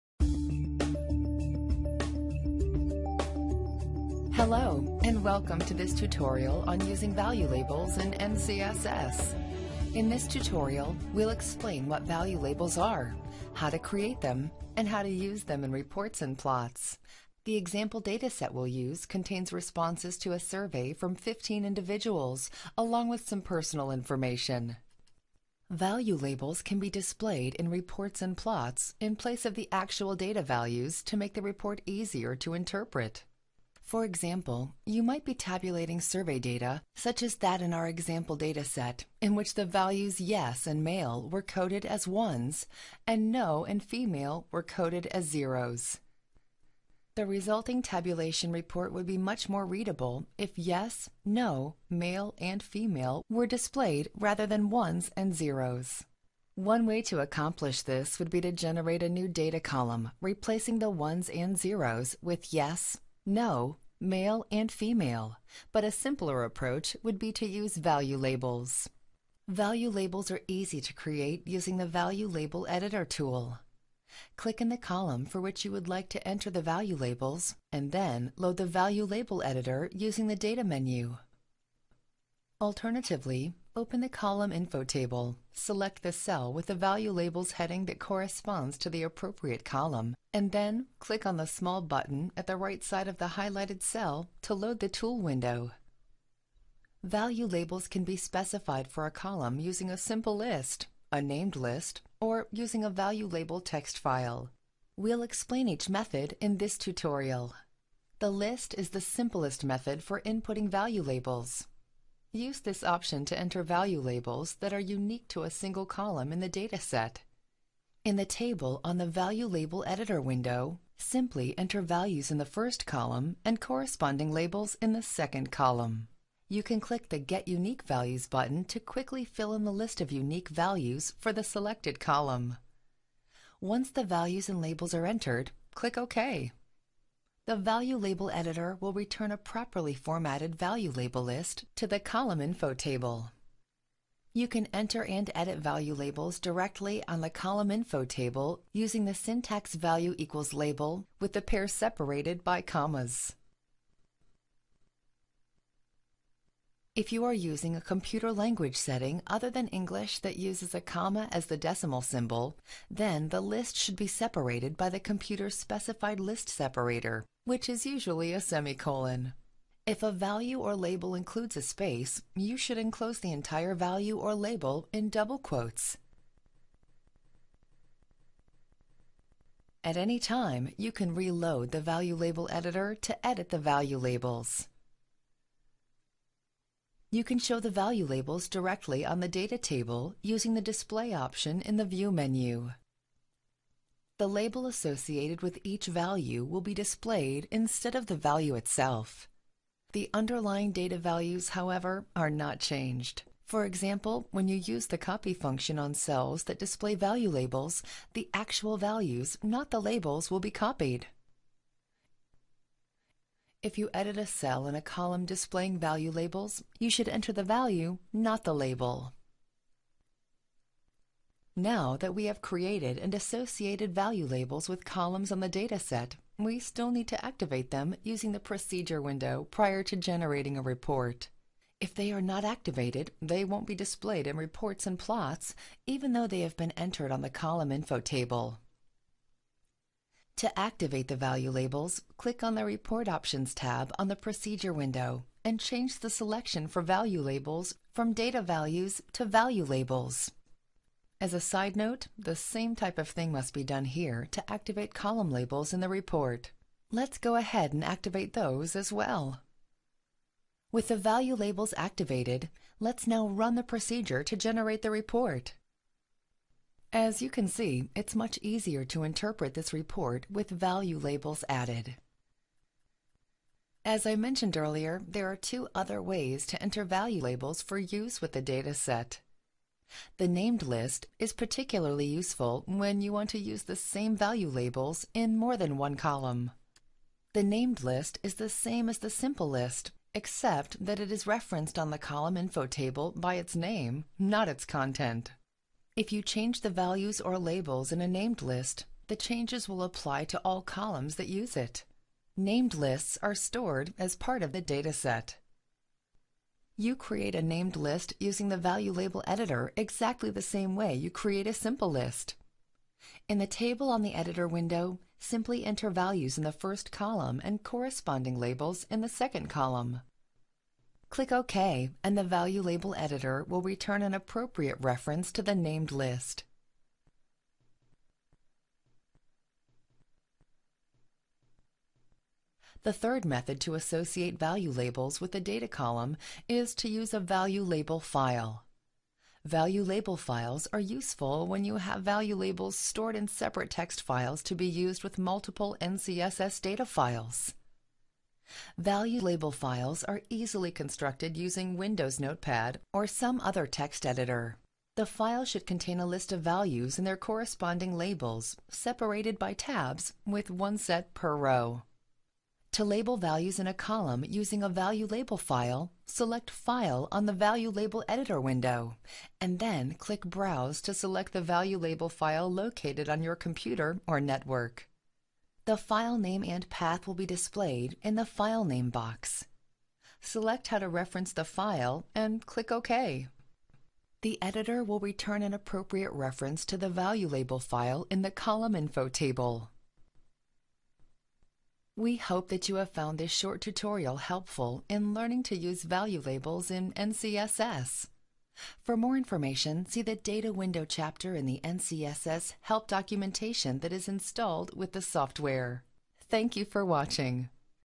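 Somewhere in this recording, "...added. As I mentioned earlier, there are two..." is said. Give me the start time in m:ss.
4:31.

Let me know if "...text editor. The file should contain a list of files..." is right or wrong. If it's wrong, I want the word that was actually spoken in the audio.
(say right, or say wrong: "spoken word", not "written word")
wrong: "values", not "files".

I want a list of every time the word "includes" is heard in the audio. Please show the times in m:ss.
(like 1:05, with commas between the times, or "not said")
2:51.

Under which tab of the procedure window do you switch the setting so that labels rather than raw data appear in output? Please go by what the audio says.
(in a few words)
Report Options.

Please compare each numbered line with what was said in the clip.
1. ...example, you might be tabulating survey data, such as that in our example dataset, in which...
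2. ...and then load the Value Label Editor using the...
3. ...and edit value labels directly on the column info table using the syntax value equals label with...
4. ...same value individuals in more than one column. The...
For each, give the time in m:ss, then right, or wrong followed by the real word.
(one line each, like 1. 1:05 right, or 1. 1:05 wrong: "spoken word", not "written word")
1. 0:34 right
2. 1:17 right
3. 2:25 right
4. 4:43 wrong: "labels", not "individuals".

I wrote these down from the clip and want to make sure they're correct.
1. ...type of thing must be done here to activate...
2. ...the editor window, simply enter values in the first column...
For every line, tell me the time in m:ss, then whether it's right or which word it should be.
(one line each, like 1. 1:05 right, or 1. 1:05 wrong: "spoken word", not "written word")
1. 4:12 right
2. 5:14 right.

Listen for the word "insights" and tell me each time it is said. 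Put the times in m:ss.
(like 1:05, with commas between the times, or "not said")
not said.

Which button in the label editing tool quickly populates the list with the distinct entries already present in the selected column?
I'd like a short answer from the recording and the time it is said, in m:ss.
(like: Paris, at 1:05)
Get Unique Values, at 2:07.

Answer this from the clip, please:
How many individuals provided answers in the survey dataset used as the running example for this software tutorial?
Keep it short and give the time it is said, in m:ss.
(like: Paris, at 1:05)
15, at 0:21.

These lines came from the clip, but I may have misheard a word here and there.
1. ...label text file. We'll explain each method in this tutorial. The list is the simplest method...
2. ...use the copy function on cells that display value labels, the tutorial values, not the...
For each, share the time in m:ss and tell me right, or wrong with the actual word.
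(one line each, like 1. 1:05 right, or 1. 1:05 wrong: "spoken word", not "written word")
1. 1:43 right
2. 3:24 wrong: "actual", not "tutorial".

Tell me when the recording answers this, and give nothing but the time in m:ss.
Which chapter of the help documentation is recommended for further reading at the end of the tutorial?
6:40.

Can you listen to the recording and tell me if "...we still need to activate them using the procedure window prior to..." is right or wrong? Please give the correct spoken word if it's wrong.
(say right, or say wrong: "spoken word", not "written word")
right.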